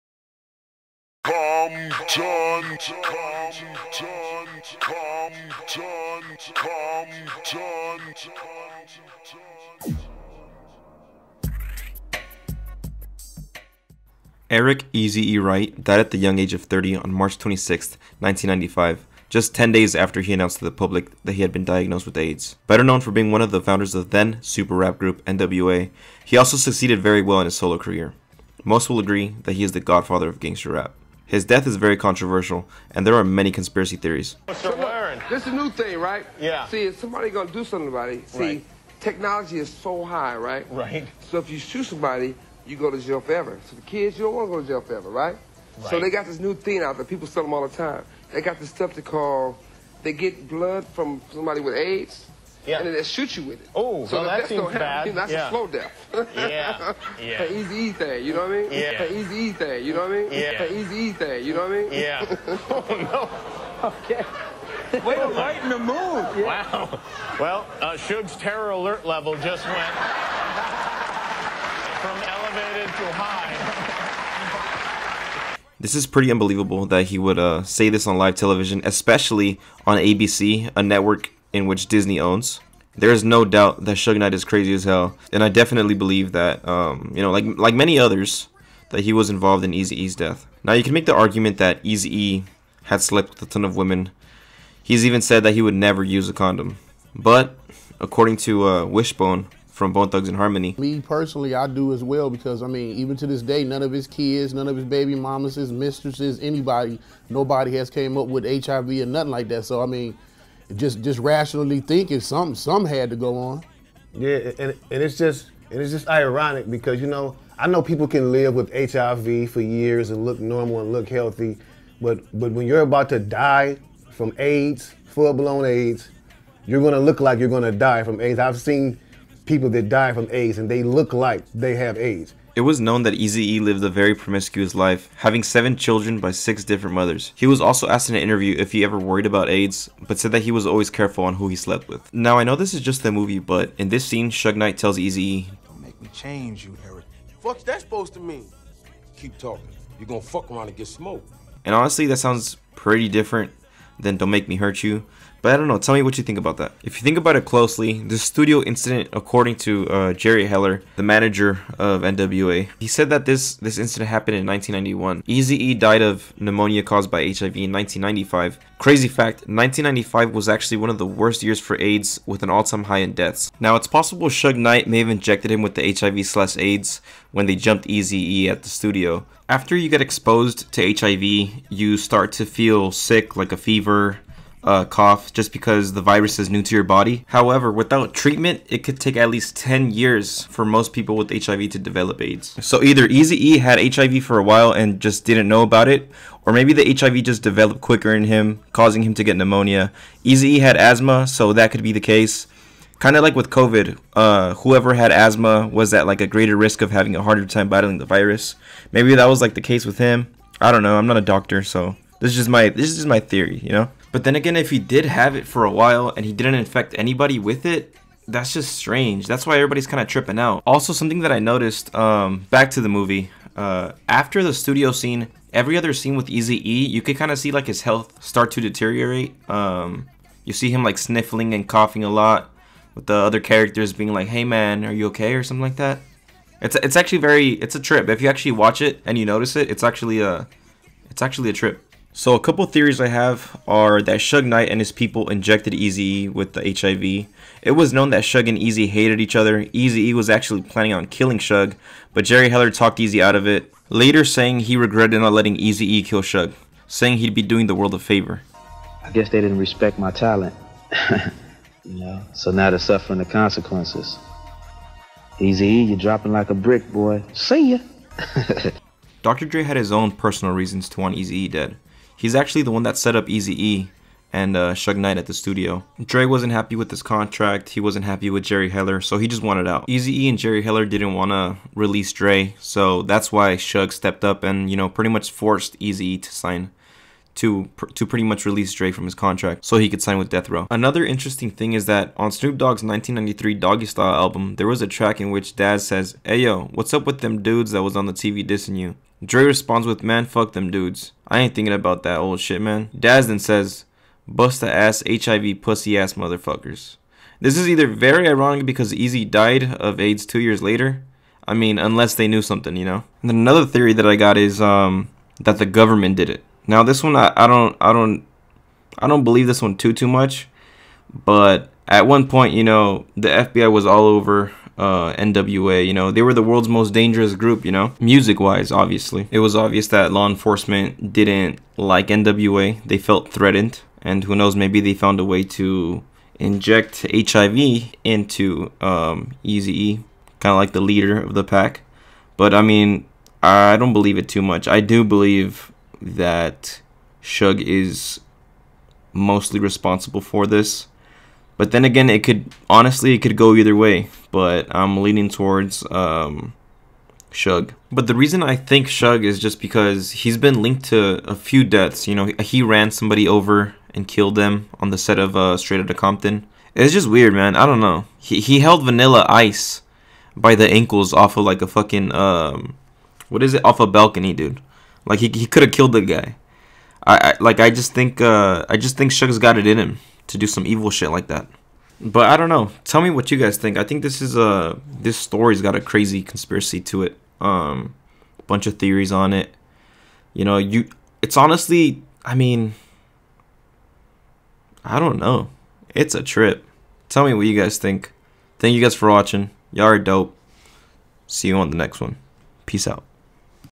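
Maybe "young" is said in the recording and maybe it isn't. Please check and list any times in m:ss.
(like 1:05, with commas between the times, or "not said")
0:16.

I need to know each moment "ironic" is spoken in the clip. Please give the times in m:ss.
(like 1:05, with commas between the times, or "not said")
1:56, 5:08.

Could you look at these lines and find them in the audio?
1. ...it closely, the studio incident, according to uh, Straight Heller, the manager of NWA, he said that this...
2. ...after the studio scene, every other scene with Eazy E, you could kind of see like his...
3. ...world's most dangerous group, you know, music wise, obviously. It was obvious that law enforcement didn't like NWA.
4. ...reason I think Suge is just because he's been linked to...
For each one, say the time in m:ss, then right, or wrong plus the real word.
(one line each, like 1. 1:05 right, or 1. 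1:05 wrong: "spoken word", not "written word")
1. 2:37 wrong: "Jerry", not "Straight"
2. 3:44 right
3. 5:26 right
4. 5:58 right.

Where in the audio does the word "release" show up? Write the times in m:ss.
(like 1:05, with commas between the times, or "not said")
4:41, 4:48.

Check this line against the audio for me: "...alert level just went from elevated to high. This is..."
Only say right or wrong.
right.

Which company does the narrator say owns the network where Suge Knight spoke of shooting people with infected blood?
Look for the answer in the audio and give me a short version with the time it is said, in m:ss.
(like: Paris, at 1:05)
Disney, at 1:21.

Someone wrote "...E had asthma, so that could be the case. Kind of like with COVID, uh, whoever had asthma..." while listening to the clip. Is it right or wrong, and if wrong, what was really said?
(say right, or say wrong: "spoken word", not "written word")
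right.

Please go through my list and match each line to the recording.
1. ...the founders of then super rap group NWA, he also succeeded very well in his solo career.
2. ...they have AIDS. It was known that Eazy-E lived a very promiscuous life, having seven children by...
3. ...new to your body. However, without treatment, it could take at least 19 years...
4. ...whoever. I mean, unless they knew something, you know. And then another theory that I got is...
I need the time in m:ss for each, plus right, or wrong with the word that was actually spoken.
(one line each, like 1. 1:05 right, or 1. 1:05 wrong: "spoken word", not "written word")
1. 0:23 right
2. 2:11 right
3. 3:06 wrong: "10", not "19"
4. 5:10 wrong: "later", not "whoever".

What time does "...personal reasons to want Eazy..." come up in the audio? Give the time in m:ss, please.
4:30.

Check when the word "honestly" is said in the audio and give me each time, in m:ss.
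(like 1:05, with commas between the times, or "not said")
2:31, 5:52, 6:31.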